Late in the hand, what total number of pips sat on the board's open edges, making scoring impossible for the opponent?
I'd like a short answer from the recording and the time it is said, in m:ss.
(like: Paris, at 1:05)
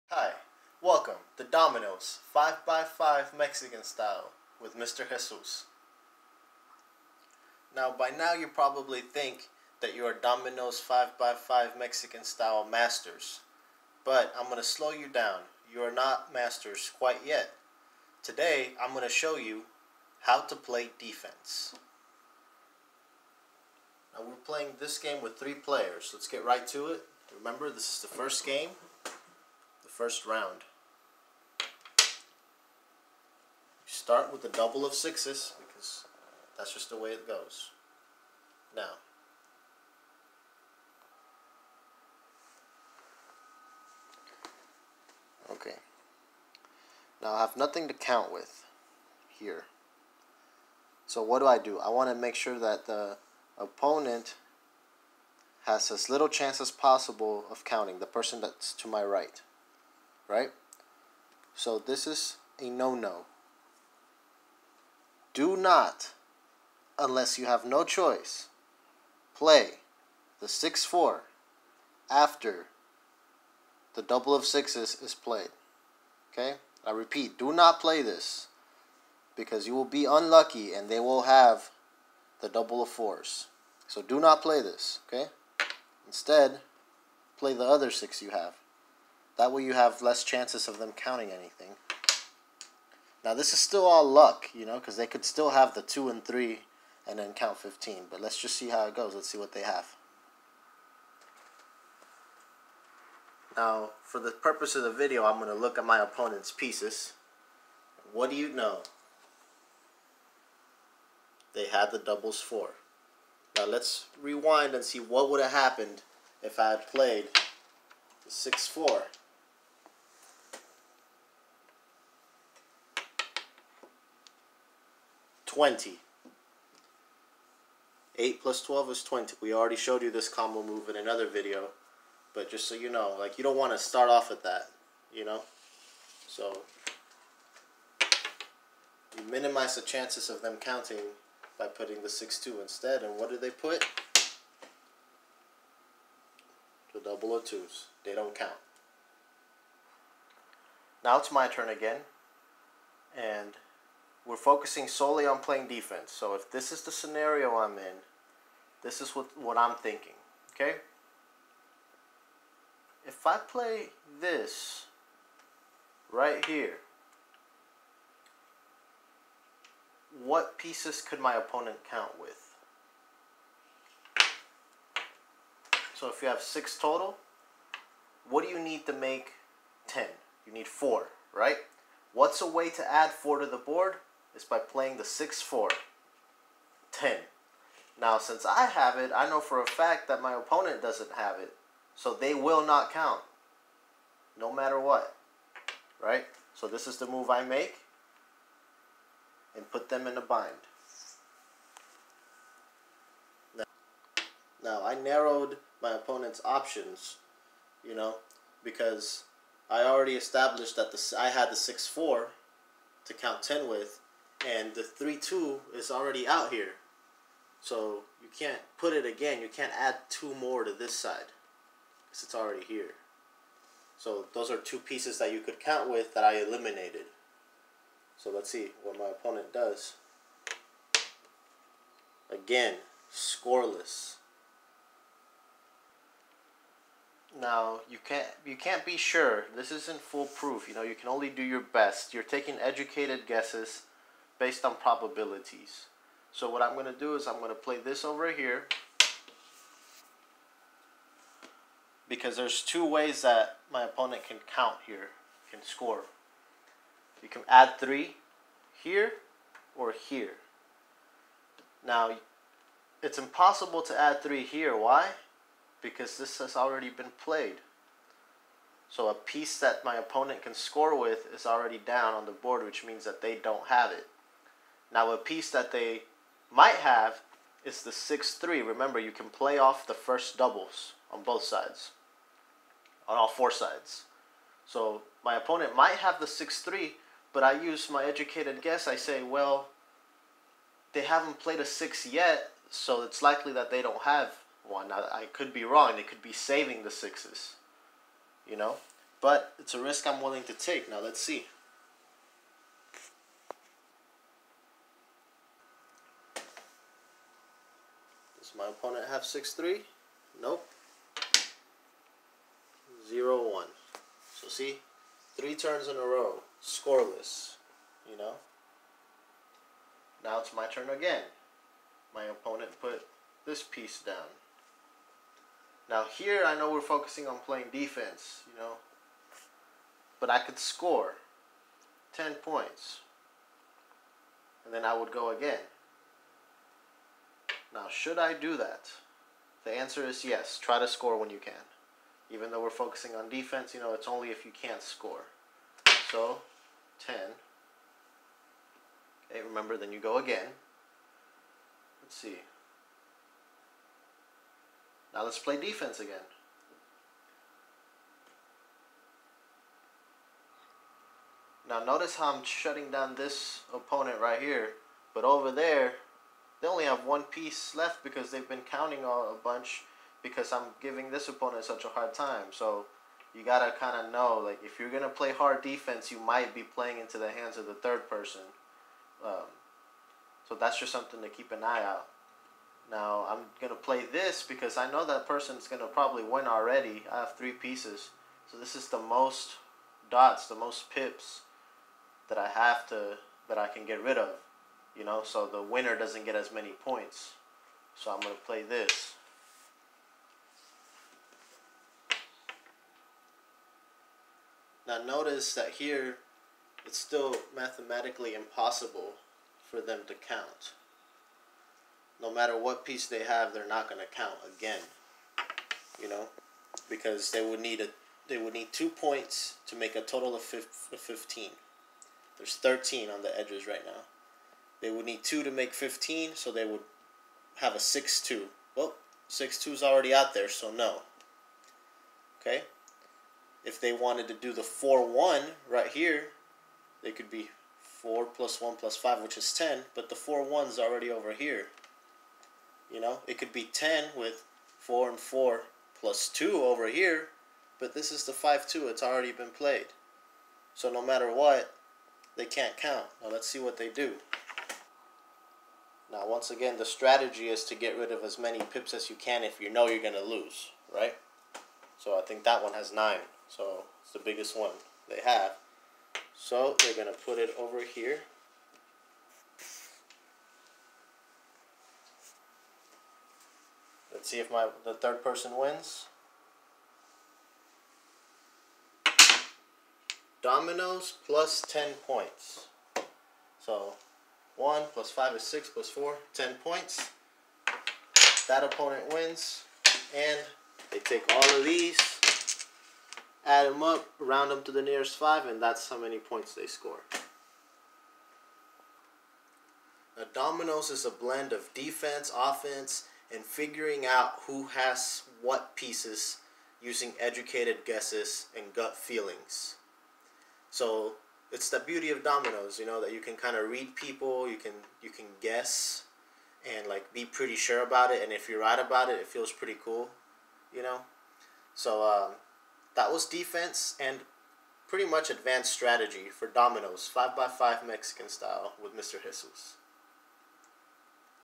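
13, at 7:02.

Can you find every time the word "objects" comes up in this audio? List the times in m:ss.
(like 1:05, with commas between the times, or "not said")
not said.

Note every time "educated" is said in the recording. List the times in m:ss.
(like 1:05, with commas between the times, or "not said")
4:02, 4:48, 8:27.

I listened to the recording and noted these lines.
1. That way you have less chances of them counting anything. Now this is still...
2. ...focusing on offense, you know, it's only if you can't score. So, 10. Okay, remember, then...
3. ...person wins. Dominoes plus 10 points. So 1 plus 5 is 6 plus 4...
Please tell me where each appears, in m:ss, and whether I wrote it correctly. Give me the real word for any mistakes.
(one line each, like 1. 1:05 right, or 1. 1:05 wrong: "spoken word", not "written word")
1. 1:29 right
2. 5:42 wrong: "defense", not "offense"
3. 7:55 right.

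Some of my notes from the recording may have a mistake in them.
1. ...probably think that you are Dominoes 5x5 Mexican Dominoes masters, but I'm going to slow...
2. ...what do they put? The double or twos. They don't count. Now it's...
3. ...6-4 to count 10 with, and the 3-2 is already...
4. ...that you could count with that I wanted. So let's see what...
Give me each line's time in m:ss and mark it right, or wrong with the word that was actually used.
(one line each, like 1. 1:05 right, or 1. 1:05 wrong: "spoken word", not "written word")
1. 0:08 wrong: "Style", not "Dominoes"
2. 2:23 right
3. 3:31 right
4. 3:45 wrong: "eliminated", not "wanted".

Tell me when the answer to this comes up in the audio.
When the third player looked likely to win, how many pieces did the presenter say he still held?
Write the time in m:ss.
6:27.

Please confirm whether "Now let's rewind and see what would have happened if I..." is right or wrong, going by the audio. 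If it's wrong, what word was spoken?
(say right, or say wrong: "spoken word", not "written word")
right.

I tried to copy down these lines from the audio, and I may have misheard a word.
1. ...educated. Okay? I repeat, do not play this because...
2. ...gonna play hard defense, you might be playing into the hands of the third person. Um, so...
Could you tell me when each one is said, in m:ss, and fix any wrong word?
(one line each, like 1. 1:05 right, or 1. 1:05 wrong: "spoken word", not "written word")
1. 1:15 wrong: "played", not "educated"
2. 6:14 right.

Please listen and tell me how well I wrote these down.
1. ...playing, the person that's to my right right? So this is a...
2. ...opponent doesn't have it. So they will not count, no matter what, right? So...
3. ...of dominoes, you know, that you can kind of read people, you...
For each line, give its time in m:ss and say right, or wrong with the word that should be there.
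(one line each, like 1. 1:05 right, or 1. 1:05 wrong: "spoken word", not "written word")
1. 0:57 wrong: "counting", not "playing"
2. 3:10 right
3. 8:32 right.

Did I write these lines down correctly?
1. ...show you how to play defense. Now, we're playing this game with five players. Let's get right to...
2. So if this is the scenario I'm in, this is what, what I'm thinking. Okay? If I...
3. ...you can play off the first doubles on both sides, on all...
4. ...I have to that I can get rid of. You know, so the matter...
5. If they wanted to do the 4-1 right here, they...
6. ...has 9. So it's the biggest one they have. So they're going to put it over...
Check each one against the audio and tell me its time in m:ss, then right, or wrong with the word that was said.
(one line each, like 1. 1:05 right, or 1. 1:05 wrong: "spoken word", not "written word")
1. 0:19 wrong: "three", not "five"
2. 2:36 right
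3. 4:38 right
4. 6:32 wrong: "winner", not "matter"
5. 7:13 right
6. 7:42 right.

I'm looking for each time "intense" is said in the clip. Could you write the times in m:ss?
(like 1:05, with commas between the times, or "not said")
not said.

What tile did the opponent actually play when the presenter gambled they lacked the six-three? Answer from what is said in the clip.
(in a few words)
0-1.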